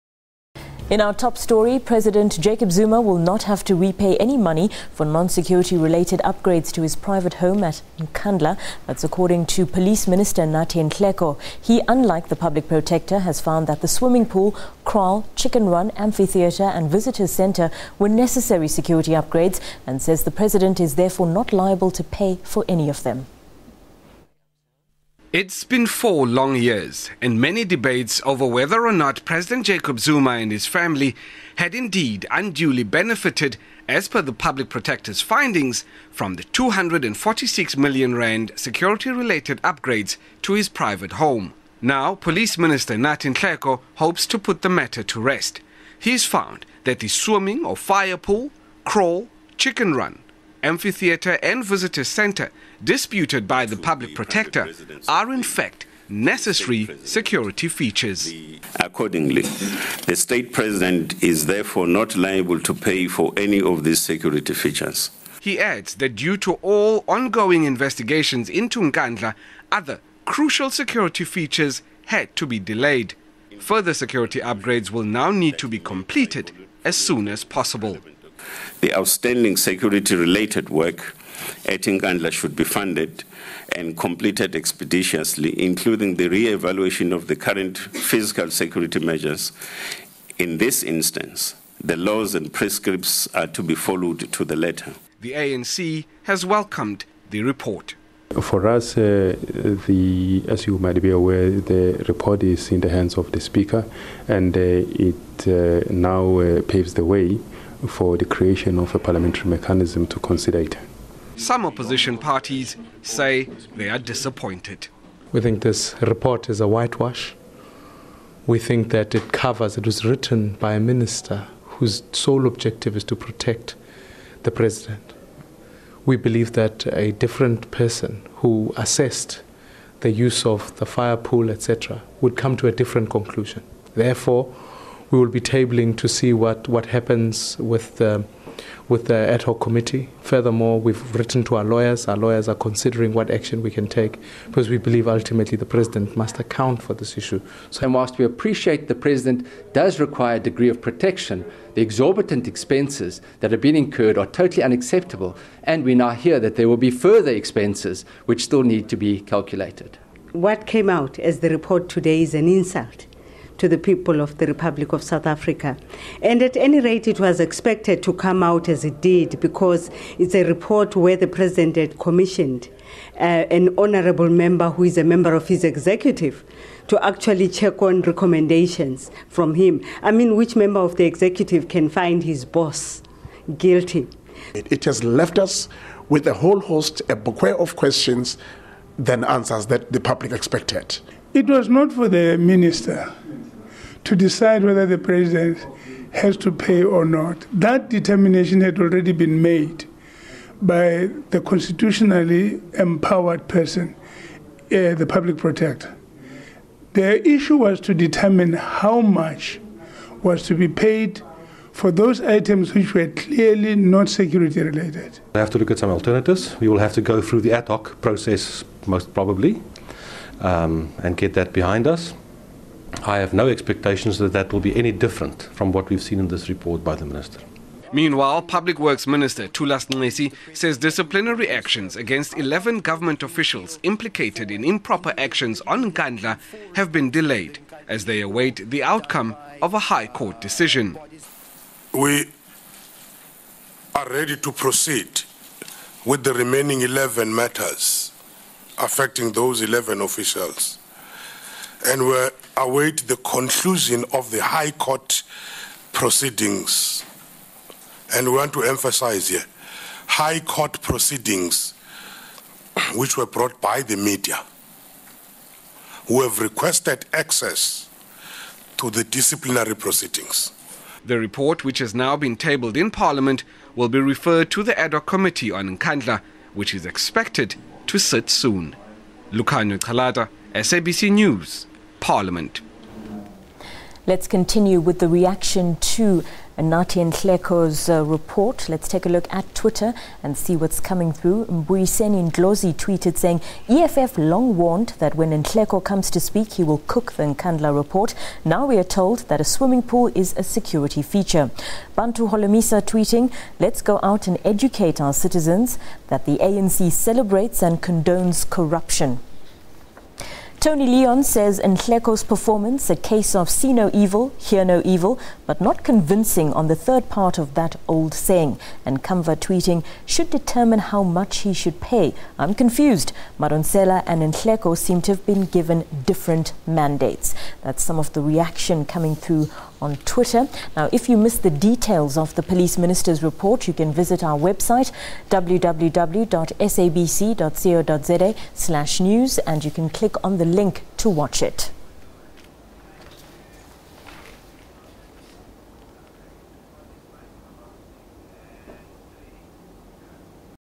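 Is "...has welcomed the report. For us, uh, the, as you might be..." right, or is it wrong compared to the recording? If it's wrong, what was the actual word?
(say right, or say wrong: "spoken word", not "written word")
right.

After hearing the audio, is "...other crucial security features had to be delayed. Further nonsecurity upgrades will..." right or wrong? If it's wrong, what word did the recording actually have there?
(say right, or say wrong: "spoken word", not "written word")
wrong: "security", not "nonsecurity".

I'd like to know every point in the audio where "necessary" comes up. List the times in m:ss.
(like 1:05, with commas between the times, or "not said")
0:18, 0:56.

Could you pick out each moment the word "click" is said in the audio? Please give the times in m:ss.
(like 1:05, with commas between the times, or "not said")
5:39.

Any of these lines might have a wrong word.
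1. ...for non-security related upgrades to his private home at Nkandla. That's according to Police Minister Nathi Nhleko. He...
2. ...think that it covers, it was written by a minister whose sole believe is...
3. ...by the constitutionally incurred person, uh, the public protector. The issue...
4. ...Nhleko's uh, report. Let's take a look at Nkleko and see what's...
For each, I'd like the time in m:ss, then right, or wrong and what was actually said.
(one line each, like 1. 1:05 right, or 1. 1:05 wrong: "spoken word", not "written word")
1. 0:04 right
2. 1:58 wrong: "objective", not "believe"
3. 3:20 wrong: "empowered", not "incurred"
4. 4:47 wrong: "Twitter", not "Nkleko".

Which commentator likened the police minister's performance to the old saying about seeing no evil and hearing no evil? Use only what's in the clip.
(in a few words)
Tony Leon.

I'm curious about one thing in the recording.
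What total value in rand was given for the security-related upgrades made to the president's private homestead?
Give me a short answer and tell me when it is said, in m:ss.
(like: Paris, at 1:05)
246 million rand, at 0:36.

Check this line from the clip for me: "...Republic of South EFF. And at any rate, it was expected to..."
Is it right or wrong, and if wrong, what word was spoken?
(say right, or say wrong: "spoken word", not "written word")
wrong: "Africa", not "EFF".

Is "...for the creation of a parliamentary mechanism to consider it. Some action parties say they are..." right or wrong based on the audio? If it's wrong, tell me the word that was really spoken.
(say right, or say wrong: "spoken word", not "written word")
wrong: "opposition", not "action".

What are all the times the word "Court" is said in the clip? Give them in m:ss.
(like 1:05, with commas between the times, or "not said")
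4:00, 4:14, 4:20.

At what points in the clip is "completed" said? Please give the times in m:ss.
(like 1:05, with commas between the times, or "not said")
1:15, 1:23.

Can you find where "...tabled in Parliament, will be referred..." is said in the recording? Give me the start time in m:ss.
4:32.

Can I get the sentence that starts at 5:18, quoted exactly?
And Kamva tweeting, should determine how much he should pay.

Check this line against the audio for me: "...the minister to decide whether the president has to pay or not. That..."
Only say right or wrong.
right.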